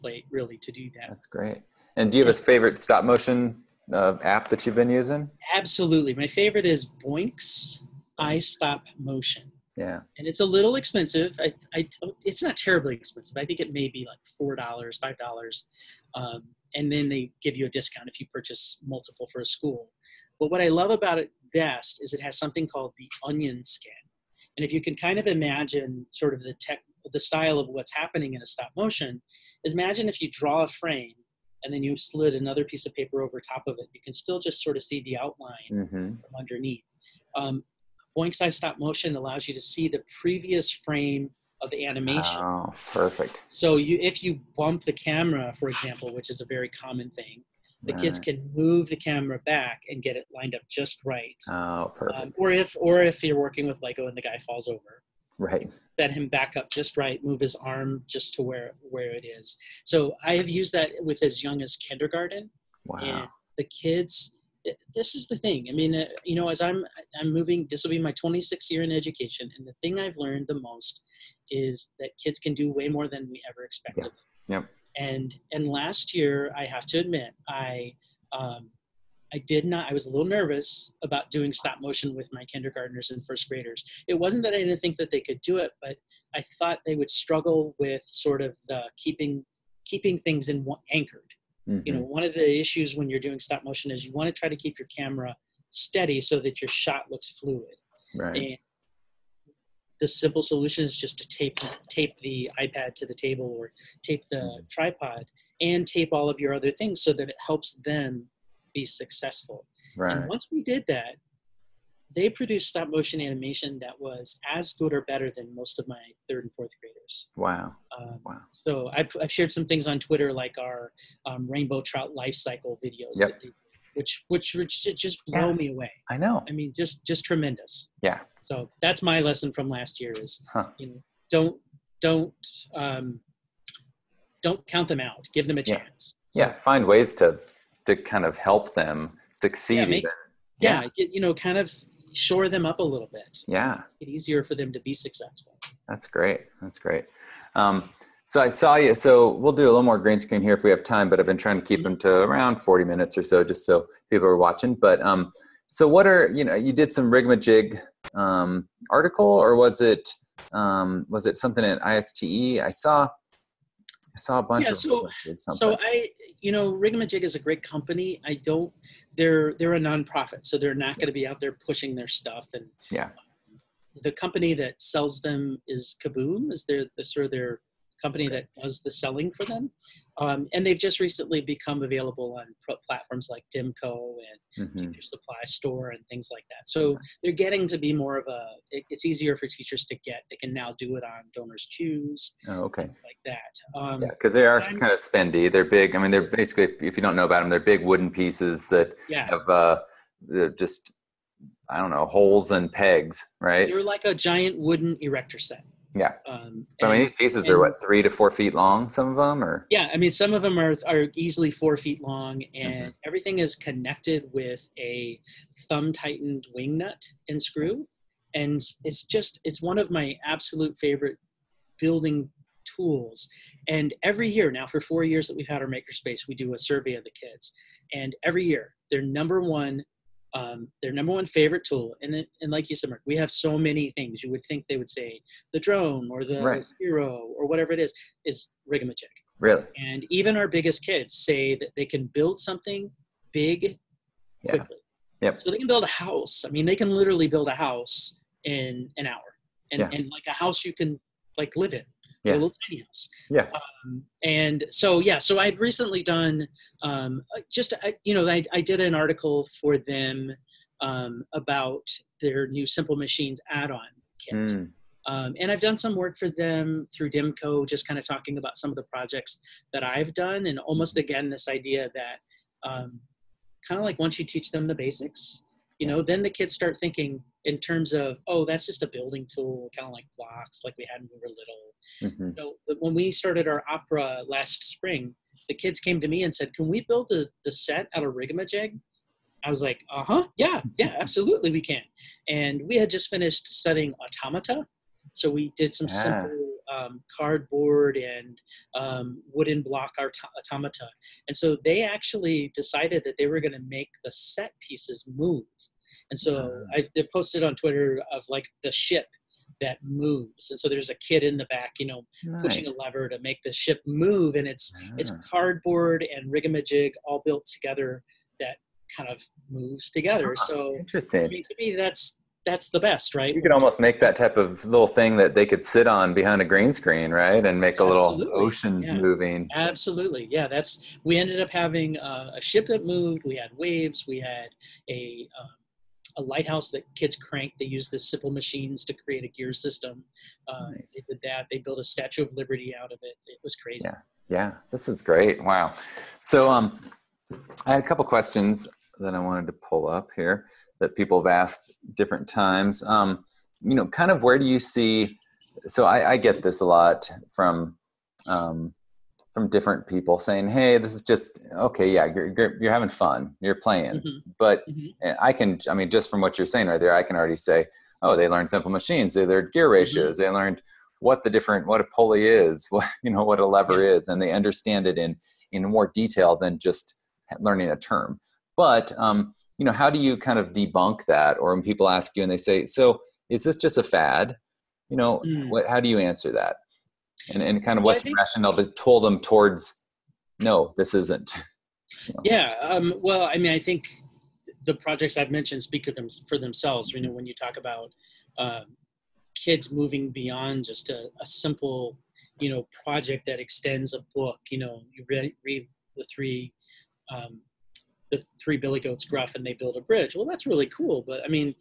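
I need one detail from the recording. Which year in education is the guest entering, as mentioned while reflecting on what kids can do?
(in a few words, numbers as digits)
26th.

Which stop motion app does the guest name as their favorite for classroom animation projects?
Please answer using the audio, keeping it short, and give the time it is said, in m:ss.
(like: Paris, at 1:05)
Boinx iStopMotion, at 0:38.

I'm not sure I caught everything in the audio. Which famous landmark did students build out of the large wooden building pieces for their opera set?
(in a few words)
Statue of Liberty.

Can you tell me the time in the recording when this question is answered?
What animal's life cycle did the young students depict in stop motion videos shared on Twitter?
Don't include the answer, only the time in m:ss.
2:01.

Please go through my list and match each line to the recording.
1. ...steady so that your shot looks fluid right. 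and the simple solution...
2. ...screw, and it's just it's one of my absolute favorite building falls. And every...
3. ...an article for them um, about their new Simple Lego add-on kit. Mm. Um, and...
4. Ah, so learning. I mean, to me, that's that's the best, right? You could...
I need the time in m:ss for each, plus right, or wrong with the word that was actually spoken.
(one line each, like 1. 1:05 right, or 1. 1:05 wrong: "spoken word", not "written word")
1. 1:35 right
2. 3:37 wrong: "tools", not "falls"
3. 4:18 wrong: "Machines", not "Lego"
4. 5:20 wrong: "interesting", not "learning".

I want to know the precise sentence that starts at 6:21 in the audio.
Or when people ask you and they say, "So, is this just a fad?" You know, mm.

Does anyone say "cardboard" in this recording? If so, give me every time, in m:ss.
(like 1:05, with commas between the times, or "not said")
4:57, 5:15.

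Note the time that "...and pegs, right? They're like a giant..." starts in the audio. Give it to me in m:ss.
3:22.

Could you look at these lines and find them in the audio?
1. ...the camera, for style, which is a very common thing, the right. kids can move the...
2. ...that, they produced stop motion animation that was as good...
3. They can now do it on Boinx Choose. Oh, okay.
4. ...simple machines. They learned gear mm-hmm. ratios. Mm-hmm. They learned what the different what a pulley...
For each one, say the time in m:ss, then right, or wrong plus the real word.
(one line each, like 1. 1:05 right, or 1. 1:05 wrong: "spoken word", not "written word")
1. 0:44 wrong: "example", not "style"
2. 1:50 right
3. 3:10 wrong: "Donors", not "Boinx"
4. 6:08 right.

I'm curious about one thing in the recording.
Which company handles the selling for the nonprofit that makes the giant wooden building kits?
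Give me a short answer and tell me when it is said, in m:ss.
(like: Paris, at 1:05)
Kaboom, at 2:56.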